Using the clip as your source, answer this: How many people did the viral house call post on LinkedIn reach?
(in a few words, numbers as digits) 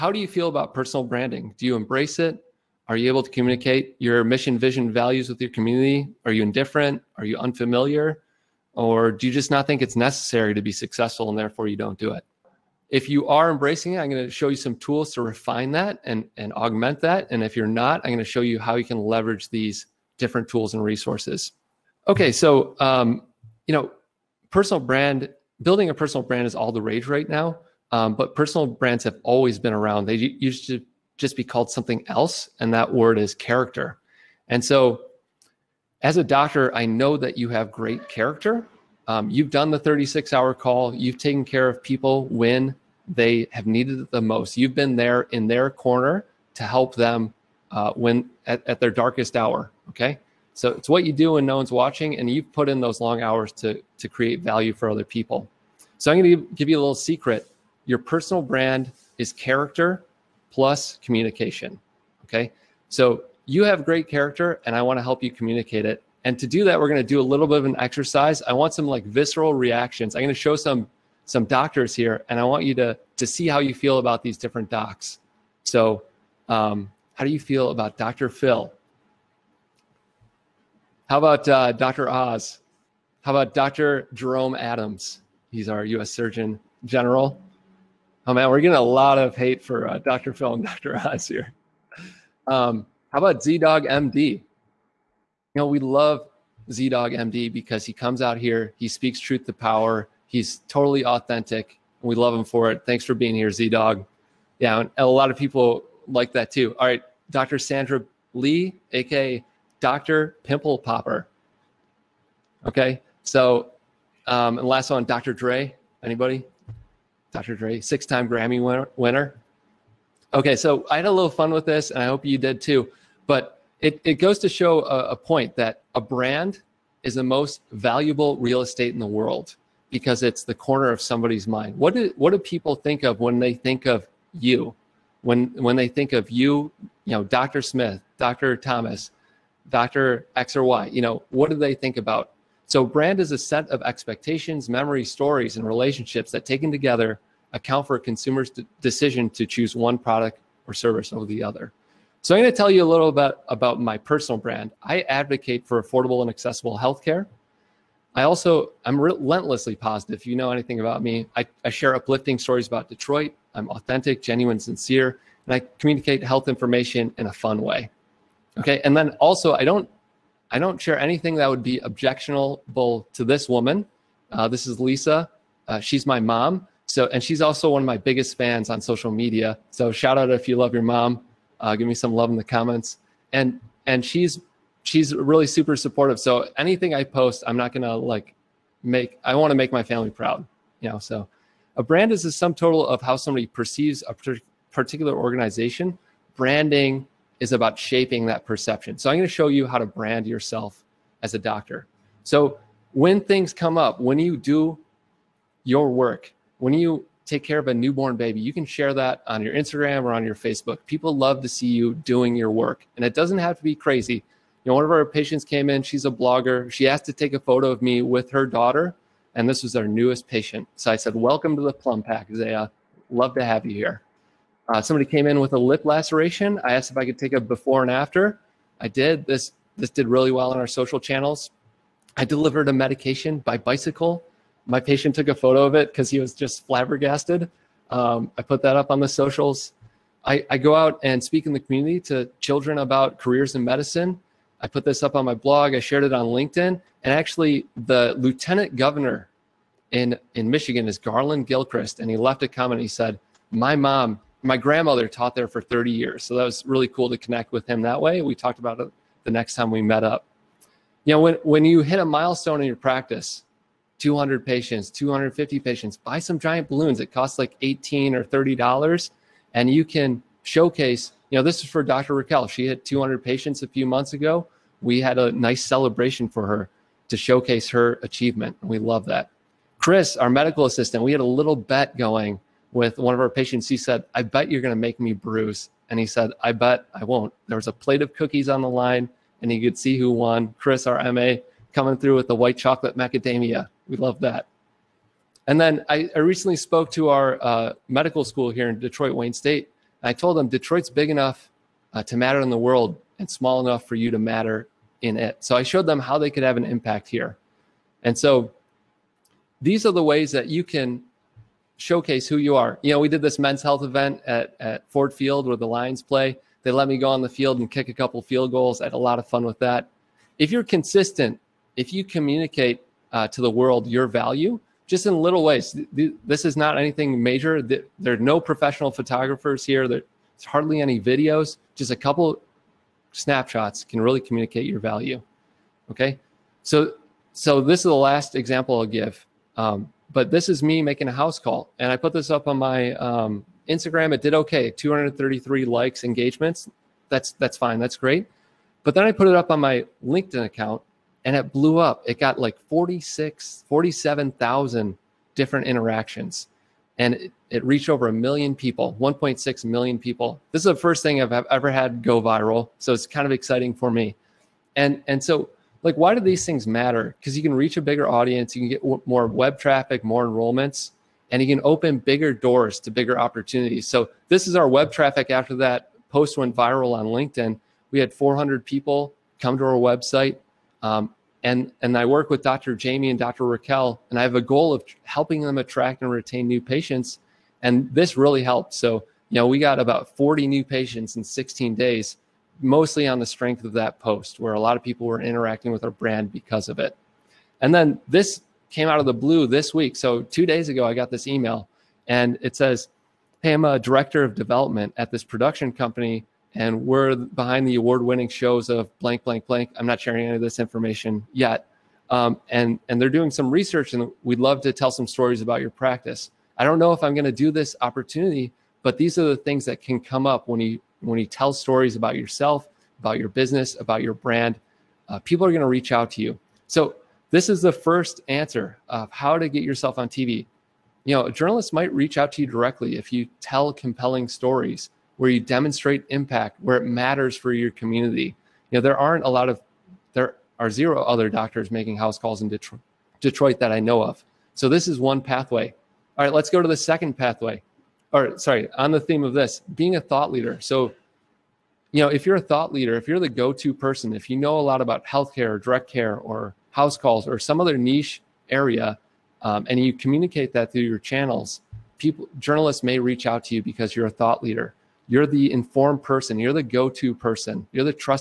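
1.6 million.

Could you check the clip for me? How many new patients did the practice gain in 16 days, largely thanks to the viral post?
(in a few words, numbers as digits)
40.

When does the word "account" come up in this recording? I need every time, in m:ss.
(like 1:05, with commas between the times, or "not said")
2:27, 5:50.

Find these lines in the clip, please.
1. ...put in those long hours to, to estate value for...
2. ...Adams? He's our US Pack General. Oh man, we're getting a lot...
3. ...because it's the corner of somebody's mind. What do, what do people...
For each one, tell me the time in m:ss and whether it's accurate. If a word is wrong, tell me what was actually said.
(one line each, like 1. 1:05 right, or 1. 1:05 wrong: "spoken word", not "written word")
1. 0:52 wrong: "create", not "estate"
2. 1:24 wrong: "Surgeon", not "Pack"
3. 2:09 right.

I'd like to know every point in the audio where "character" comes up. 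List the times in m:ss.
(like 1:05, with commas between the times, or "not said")
0:33, 0:38, 0:59, 1:04.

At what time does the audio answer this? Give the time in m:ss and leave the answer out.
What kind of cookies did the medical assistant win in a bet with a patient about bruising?
4:52.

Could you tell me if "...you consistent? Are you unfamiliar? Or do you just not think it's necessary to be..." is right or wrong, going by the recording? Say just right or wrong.
wrong.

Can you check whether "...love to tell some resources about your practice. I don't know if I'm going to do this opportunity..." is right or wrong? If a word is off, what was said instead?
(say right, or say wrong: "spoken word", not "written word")
wrong: "stories", not "resources".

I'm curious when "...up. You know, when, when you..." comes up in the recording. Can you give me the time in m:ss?
4:20.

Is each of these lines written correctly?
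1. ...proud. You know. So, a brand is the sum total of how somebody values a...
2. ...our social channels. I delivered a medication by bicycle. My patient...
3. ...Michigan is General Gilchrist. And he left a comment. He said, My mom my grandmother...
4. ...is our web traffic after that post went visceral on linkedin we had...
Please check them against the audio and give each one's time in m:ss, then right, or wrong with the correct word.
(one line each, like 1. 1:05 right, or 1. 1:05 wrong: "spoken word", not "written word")
1. 3:10 wrong: "perceives", not "values"
2. 3:50 right
3. 4:10 wrong: "Garlin", not "General"
4. 6:14 wrong: "viral", not "visceral".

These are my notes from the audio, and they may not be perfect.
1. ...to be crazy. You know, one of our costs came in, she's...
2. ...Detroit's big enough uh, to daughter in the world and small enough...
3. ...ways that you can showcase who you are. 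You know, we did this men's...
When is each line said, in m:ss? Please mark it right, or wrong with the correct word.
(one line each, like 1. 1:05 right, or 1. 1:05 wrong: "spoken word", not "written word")
1. 3:33 wrong: "patients", not "costs"
2. 5:00 wrong: "matter", not "daughter"
3. 5:10 right.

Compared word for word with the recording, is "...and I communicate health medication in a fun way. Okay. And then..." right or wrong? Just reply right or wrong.
wrong.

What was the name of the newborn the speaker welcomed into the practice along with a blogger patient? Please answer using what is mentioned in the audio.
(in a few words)
Zaya.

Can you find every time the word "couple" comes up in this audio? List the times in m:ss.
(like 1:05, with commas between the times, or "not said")
5:17, 5:31.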